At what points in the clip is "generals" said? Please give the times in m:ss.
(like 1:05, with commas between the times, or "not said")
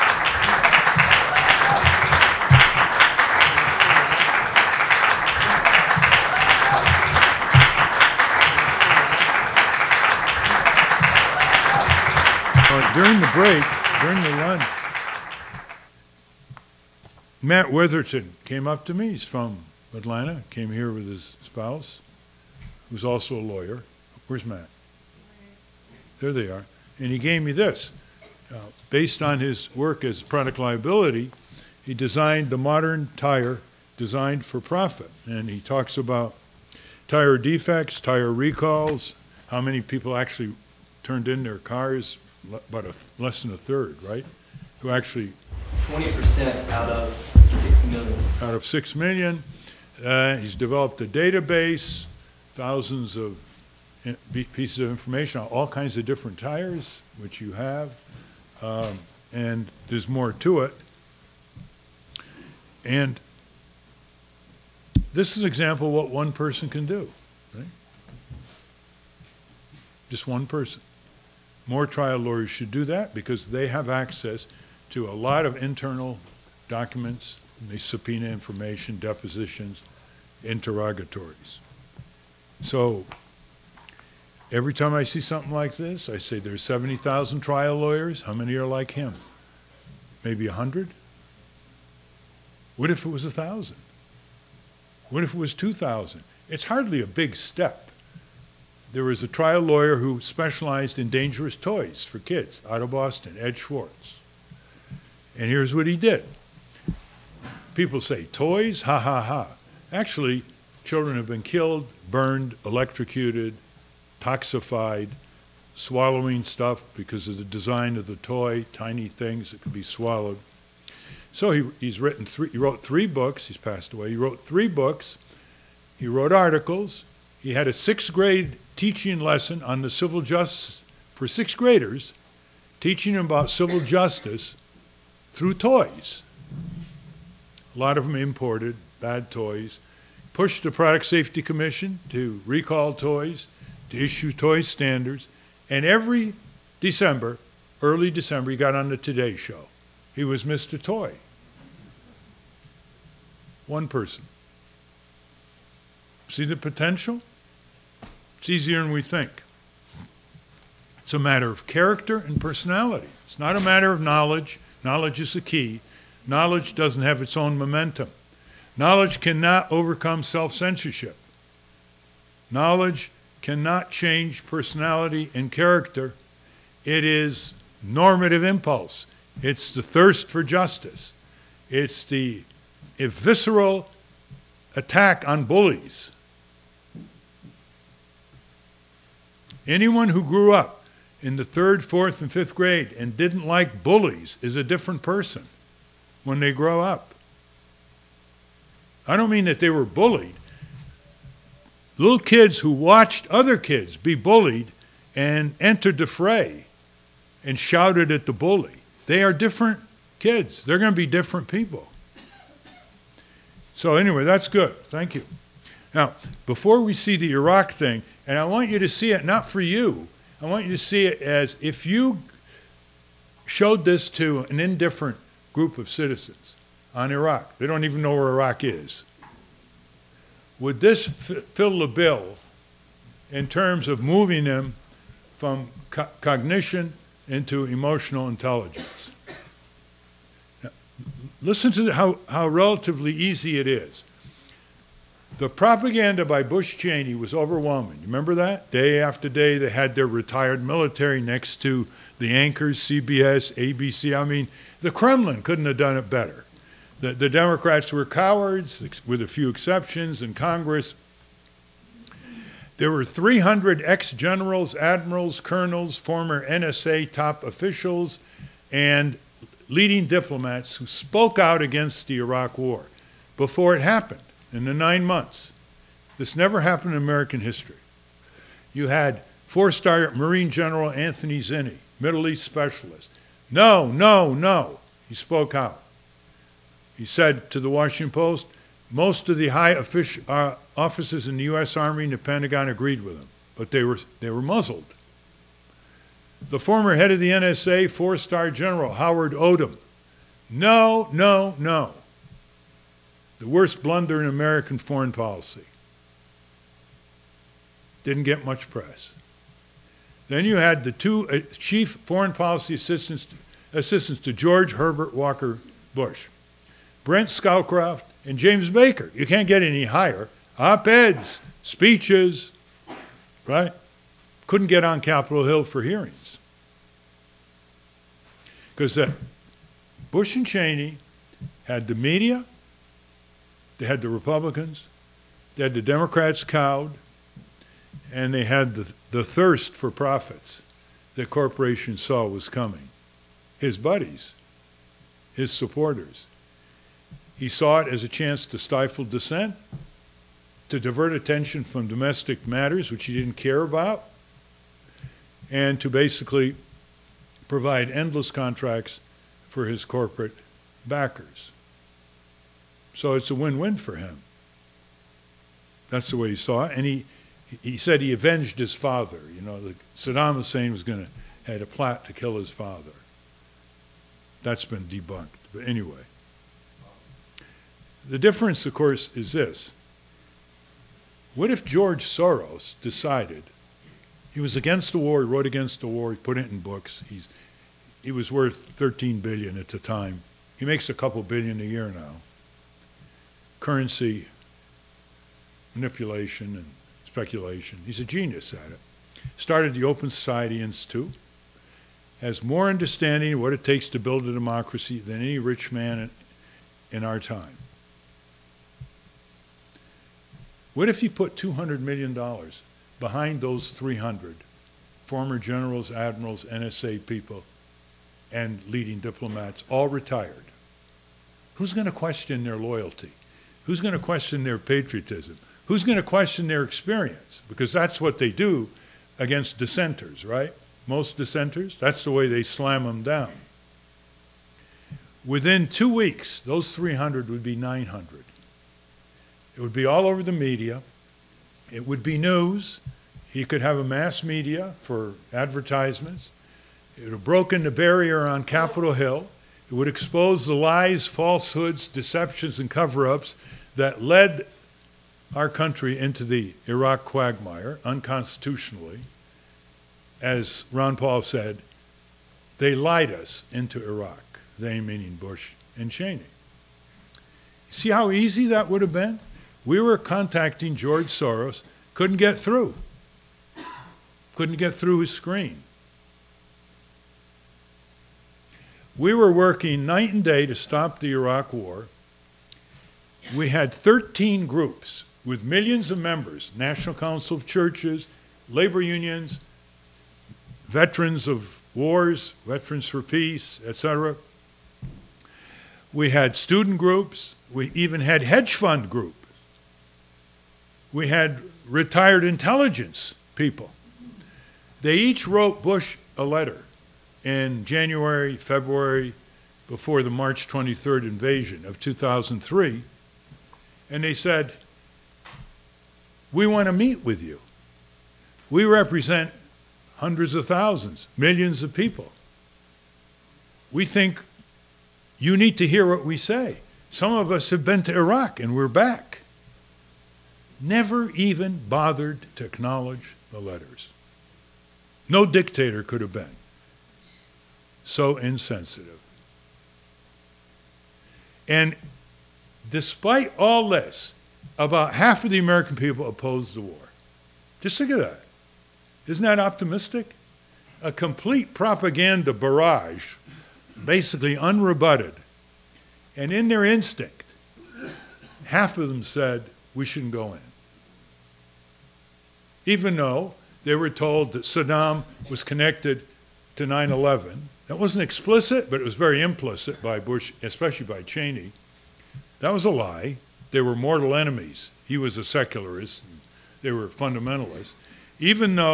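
4:24, 4:40, 4:58, 6:55.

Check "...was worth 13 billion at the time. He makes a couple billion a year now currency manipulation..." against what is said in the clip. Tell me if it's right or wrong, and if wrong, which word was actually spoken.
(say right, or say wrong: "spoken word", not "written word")
right.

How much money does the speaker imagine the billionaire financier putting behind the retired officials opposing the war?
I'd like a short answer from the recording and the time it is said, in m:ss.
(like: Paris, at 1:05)
$200 million, at 6:51.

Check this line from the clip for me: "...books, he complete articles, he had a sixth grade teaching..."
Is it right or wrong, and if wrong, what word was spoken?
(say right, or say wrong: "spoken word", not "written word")
wrong: "wrote", not "complete".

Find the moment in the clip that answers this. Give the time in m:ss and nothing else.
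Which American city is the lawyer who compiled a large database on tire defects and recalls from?
0:19.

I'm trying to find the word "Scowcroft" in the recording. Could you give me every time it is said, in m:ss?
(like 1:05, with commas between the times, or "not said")
5:17.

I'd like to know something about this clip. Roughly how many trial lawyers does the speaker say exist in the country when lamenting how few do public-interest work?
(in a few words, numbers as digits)
70,000.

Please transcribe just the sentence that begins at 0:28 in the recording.
Uh, based on his work as product liability, he designed the modern tire designed for profit.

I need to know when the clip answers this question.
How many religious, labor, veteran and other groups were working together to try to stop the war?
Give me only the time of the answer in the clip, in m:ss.
8:03.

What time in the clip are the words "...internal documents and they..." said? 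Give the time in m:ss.
1:15.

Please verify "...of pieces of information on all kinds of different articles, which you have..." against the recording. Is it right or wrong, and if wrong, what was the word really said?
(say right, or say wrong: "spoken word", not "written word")
wrong: "tires", not "articles".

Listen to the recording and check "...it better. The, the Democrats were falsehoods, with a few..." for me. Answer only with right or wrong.
wrong.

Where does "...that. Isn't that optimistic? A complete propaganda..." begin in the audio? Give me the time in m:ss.
9:07.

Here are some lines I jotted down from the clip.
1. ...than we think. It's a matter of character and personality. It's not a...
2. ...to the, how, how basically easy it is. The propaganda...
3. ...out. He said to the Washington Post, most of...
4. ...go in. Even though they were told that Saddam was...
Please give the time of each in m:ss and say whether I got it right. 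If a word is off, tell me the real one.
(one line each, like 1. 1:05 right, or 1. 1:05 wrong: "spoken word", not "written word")
1. 2:38 right
2. 4:01 wrong: "relatively", not "basically"
3. 4:45 right
4. 9:20 right.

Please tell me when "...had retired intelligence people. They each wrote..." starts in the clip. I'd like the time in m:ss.
8:21.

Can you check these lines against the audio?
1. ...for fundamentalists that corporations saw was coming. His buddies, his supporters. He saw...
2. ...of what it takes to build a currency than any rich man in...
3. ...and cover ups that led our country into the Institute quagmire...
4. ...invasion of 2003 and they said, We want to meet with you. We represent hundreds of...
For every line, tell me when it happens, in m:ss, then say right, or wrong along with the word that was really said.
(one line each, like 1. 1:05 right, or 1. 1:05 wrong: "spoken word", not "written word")
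1. 5:39 wrong: "profits", not "fundamentalists"
2. 6:43 wrong: "democracy", not "currency"
3. 7:32 wrong: "Iraq", not "Institute"
4. 8:31 right.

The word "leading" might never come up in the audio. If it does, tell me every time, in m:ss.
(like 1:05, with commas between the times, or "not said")
4:29, 6:58.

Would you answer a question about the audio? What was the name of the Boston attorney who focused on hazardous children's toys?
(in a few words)
Ed Swartz.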